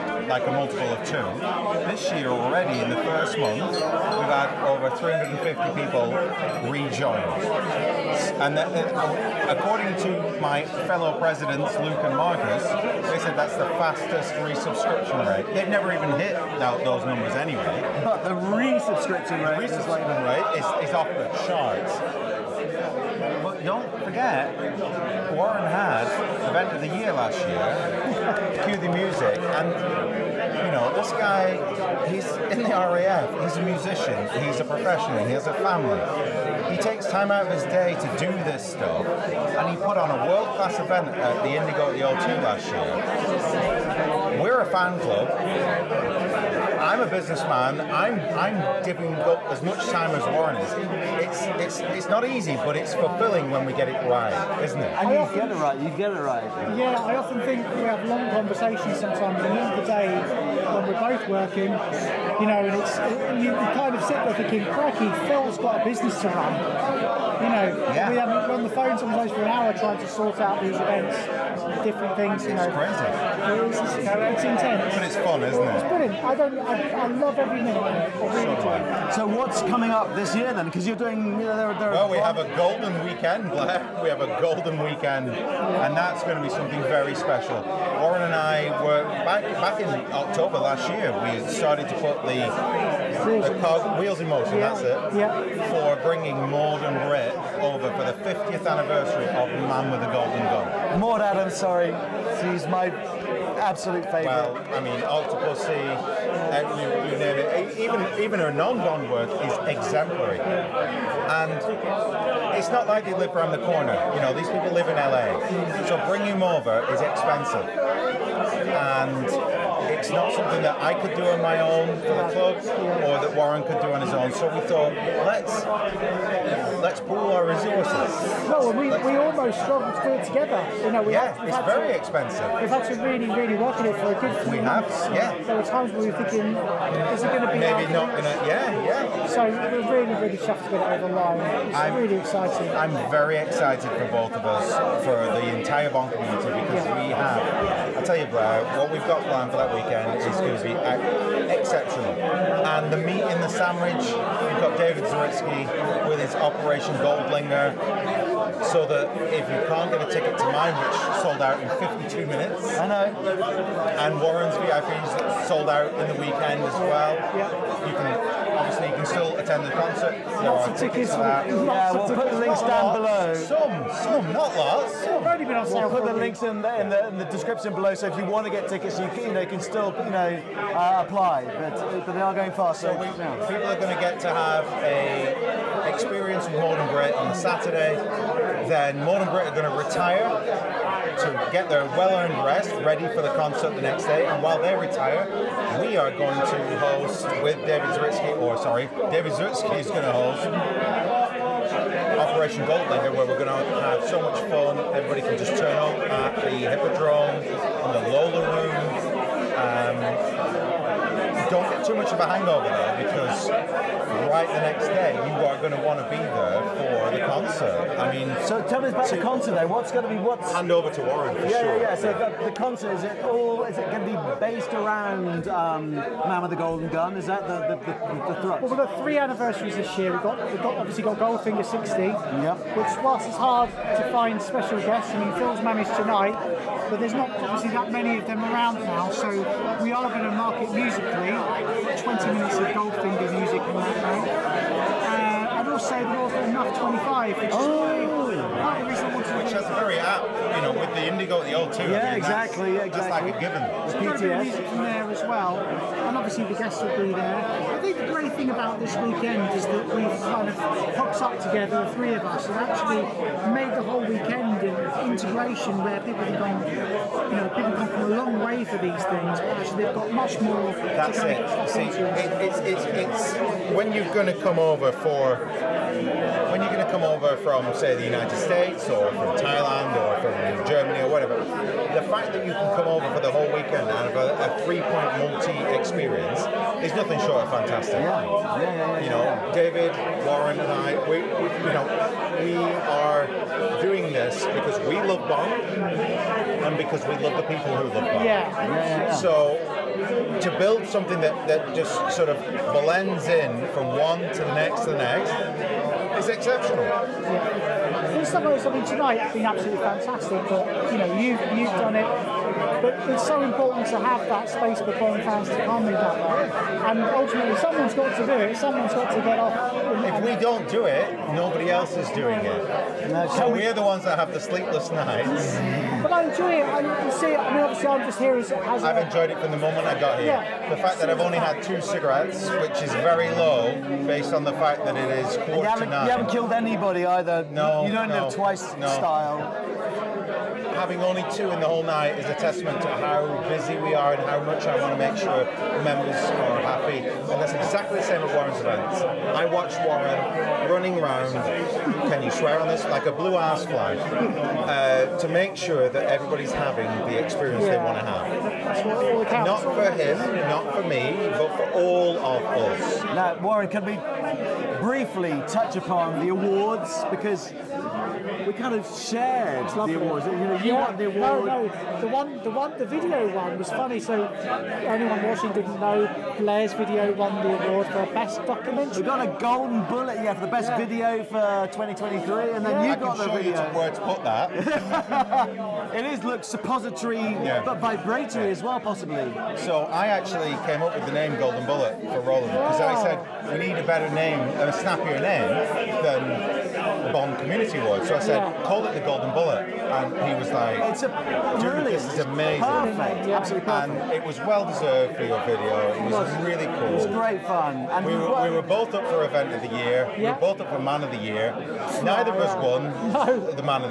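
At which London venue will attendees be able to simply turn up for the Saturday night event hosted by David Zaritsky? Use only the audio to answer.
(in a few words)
the Hippodrome.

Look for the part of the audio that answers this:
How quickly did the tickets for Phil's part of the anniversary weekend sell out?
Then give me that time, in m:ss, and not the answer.
2:42.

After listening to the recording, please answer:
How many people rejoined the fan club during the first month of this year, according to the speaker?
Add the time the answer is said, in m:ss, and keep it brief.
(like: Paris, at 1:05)
over 350, at 0:04.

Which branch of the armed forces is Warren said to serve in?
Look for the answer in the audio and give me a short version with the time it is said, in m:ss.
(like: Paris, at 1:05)
RAF, at 0:32.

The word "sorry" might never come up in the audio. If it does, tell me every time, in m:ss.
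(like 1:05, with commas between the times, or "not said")
1:41, 3:18.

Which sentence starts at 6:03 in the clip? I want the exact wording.
Now, Warren, can we briefly touch upon the awards?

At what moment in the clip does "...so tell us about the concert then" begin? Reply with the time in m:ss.
3:38.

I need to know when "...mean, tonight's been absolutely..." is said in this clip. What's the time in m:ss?
5:08.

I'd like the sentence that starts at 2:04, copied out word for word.
So we thought, let's let's pool our resources.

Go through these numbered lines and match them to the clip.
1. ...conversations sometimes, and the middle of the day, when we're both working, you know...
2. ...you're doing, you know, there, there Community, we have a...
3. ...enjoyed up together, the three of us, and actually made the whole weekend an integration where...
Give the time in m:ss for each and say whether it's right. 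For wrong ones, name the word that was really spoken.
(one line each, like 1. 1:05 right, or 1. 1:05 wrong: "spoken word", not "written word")
1. 0:58 right
2. 1:20 wrong: "Well", not "Community"
3. 4:20 wrong: "hooked", not "enjoyed".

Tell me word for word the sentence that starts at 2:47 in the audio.
you can can still attend the concert.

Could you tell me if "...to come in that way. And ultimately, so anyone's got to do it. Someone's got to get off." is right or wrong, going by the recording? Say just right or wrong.
wrong.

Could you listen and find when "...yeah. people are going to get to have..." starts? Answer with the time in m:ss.
3:03.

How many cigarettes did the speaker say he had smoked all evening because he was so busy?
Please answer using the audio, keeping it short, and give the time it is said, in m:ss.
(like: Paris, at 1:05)
2, at 5:31.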